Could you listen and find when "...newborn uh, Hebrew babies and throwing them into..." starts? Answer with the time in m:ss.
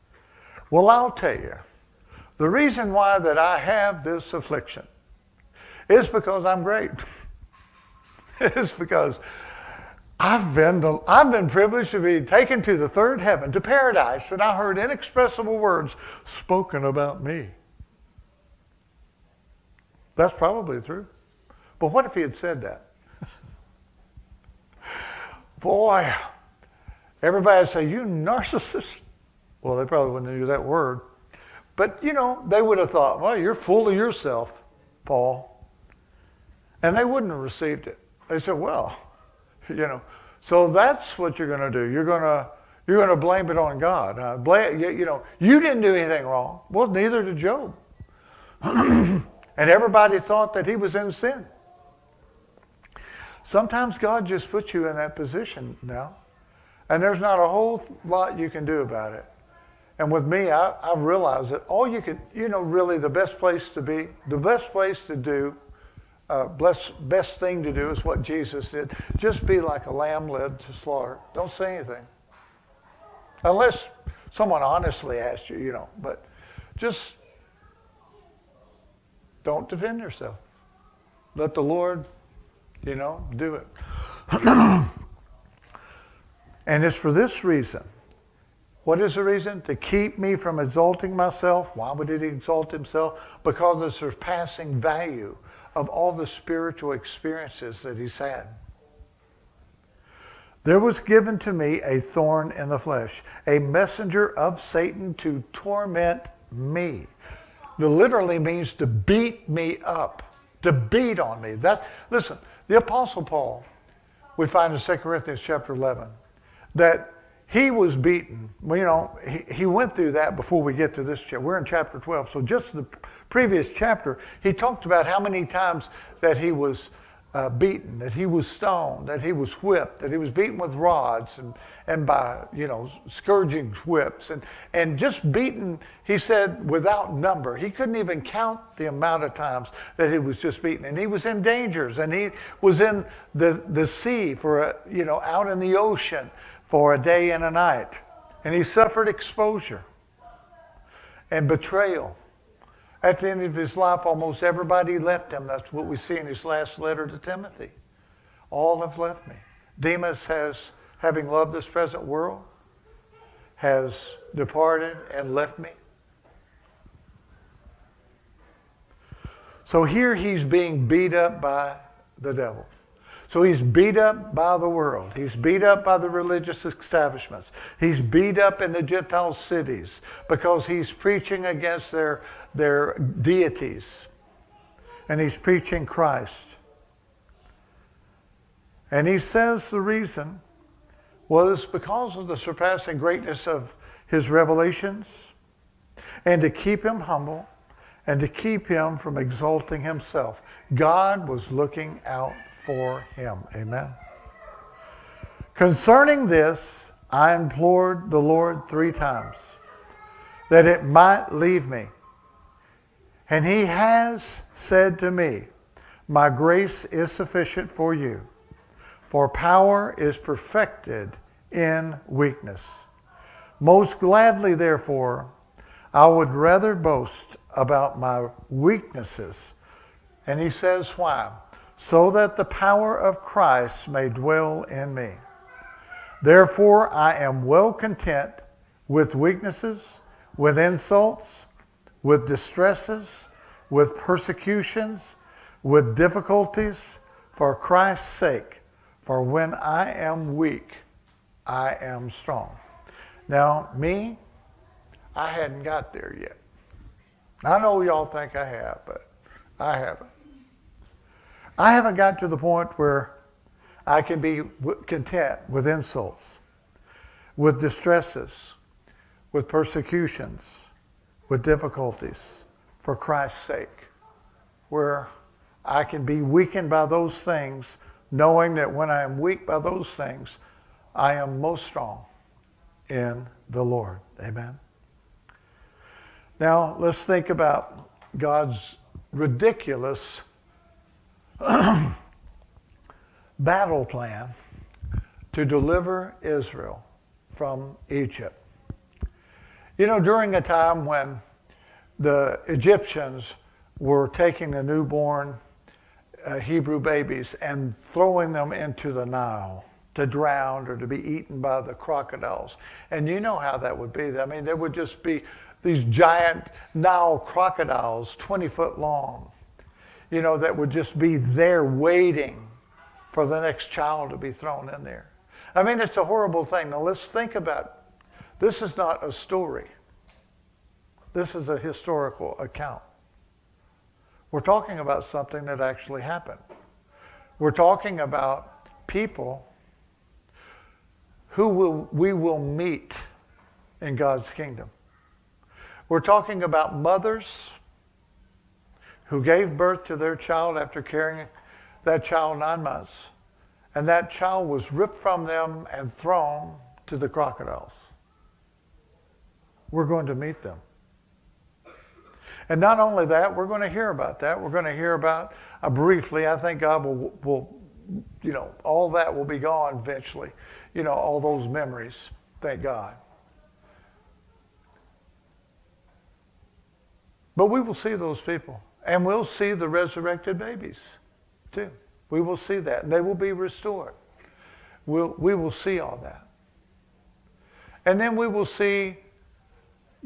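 5:04.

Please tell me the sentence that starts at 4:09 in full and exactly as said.
For when I am weak, I am strong.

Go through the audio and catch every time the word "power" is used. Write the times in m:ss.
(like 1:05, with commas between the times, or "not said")
3:39, 3:52.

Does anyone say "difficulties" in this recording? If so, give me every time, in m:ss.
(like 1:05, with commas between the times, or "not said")
4:05, 4:31.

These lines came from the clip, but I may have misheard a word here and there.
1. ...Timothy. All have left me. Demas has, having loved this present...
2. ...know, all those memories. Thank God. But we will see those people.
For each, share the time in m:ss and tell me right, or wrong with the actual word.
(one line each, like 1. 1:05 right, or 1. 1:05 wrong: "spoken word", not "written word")
1. 2:37 right
2. 6:10 right.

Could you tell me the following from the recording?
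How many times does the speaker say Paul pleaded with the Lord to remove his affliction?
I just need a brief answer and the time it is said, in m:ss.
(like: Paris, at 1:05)
3, at 3:28.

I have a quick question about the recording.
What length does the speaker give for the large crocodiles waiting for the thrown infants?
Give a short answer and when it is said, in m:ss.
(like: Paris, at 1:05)
20 feet, at 5:18.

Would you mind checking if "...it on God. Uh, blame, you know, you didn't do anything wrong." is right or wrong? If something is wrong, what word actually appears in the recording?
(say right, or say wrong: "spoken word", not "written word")
right.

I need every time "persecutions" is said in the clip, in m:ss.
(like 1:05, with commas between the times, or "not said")
4:03, 4:29.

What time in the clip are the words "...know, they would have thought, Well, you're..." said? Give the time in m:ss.
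0:32.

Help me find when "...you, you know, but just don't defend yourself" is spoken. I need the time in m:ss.
1:15.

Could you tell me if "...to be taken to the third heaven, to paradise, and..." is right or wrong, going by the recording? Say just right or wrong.
right.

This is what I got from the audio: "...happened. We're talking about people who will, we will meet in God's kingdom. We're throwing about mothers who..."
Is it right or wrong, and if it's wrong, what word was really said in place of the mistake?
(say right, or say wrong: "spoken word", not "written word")
wrong: "talking", not "throwing".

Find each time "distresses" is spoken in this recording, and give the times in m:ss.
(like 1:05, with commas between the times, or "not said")
4:02, 4:27.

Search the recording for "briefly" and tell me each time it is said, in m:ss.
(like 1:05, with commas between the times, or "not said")
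6:05.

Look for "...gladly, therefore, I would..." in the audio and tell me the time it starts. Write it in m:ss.
3:43.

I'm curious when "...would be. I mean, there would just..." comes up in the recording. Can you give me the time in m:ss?
5:13.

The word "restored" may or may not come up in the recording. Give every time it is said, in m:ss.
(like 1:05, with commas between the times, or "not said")
6:23.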